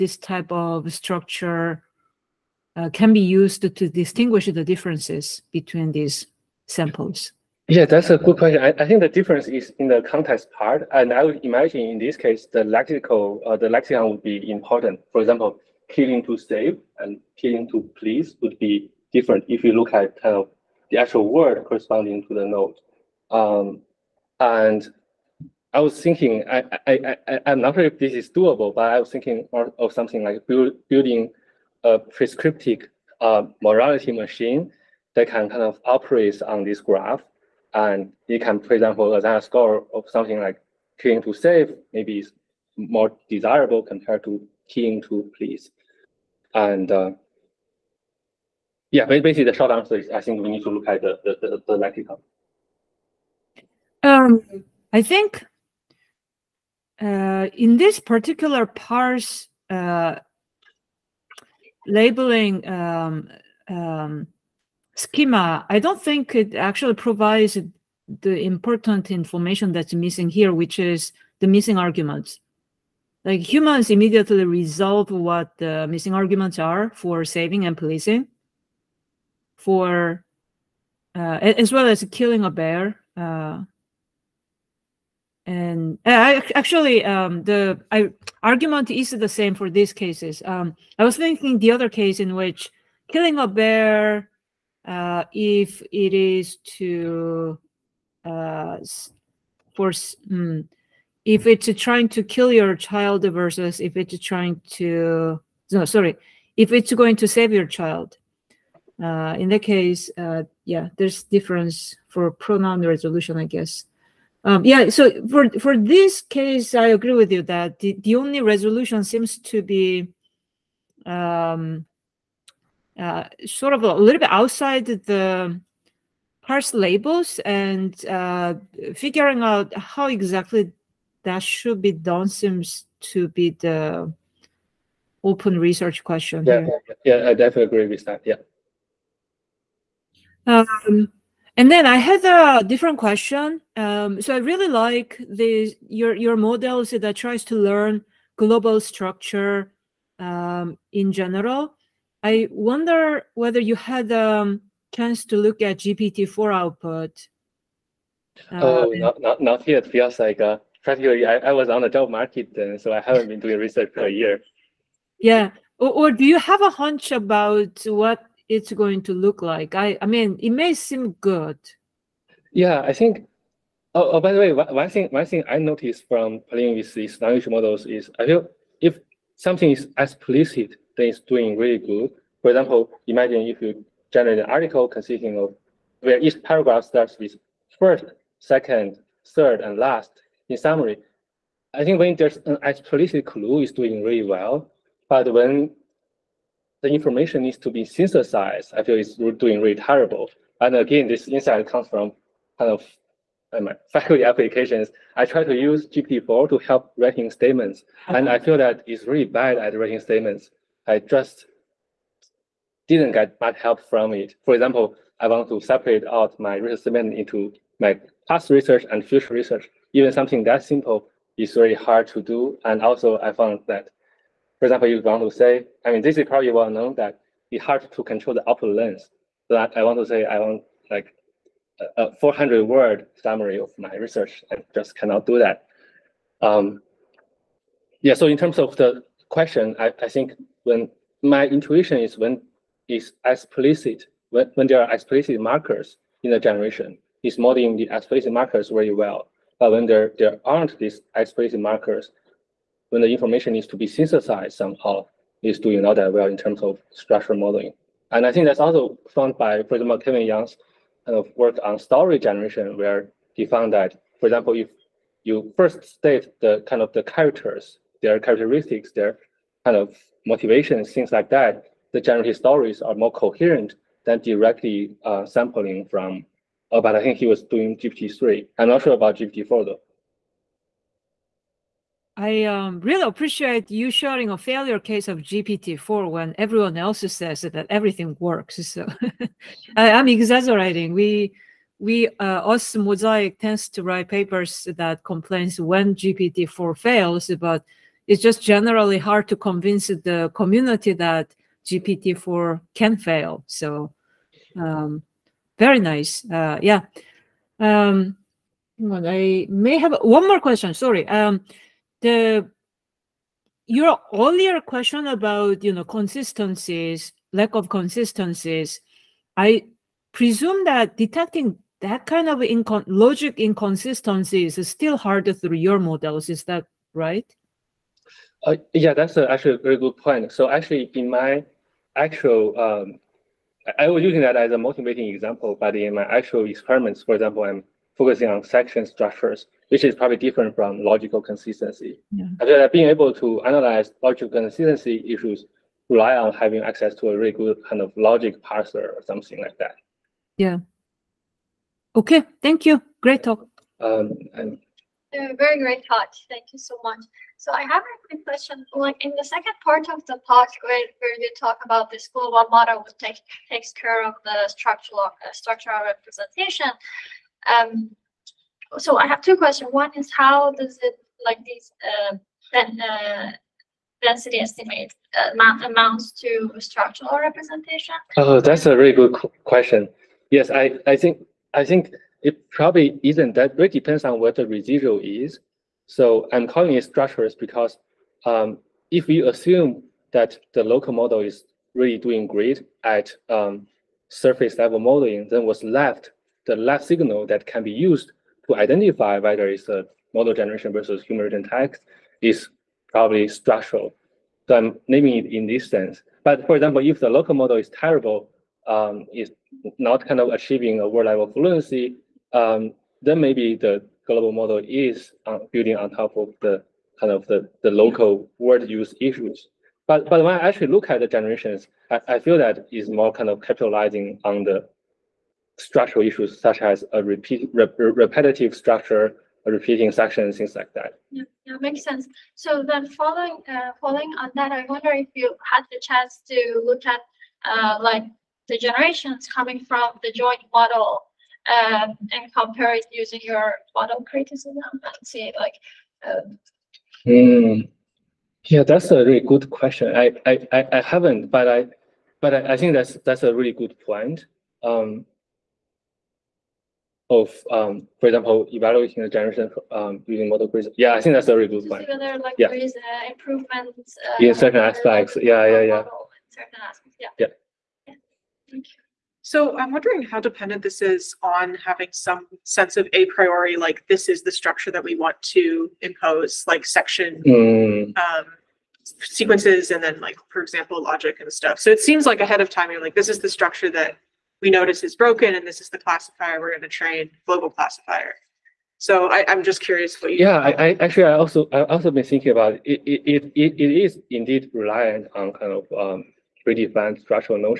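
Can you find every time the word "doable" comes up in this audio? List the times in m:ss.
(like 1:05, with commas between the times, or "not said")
0:28.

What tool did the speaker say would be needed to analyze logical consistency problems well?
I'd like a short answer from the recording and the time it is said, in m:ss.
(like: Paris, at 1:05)
logic parser, at 5:47.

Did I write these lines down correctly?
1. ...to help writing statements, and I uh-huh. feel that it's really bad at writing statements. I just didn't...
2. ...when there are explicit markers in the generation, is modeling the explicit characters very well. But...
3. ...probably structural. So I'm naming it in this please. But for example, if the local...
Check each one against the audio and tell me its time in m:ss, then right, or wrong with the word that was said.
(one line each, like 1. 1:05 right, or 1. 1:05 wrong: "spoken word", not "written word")
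1. 3:26 right
2. 4:04 wrong: "markers", not "characters"
3. 6:42 wrong: "sense", not "please".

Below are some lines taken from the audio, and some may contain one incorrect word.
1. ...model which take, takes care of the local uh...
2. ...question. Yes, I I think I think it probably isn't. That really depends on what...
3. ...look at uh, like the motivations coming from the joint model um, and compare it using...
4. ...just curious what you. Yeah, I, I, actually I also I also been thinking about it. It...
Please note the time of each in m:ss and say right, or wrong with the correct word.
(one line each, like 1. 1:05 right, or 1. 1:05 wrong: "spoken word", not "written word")
1. 6:02 wrong: "structural", not "local"
2. 6:19 right
3. 7:16 wrong: "generations", not "motivations"
4. 8:09 right.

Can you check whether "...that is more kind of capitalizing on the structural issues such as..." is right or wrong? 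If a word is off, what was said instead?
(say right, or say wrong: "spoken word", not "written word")
right.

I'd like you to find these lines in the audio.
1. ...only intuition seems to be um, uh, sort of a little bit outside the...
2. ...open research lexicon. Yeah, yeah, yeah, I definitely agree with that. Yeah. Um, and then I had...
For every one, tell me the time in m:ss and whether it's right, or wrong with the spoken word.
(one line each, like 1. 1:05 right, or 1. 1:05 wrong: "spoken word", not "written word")
1. 1:58 wrong: "resolution", not "intuition"
2. 2:15 wrong: "question", not "lexicon".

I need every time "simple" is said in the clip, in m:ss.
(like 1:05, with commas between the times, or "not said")
3:40.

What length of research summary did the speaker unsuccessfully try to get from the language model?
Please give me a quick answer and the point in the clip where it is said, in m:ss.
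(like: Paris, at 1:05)
400 word, at 3:52.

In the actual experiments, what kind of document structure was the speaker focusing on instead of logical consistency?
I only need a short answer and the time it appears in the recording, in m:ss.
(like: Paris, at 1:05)
section structures, at 5:38.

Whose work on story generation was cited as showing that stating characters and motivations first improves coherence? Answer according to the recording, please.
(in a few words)
Kevin Yang.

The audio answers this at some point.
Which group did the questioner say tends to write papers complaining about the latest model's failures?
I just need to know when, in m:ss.
4:52.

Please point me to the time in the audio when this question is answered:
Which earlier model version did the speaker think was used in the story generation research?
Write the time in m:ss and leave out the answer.
4:37.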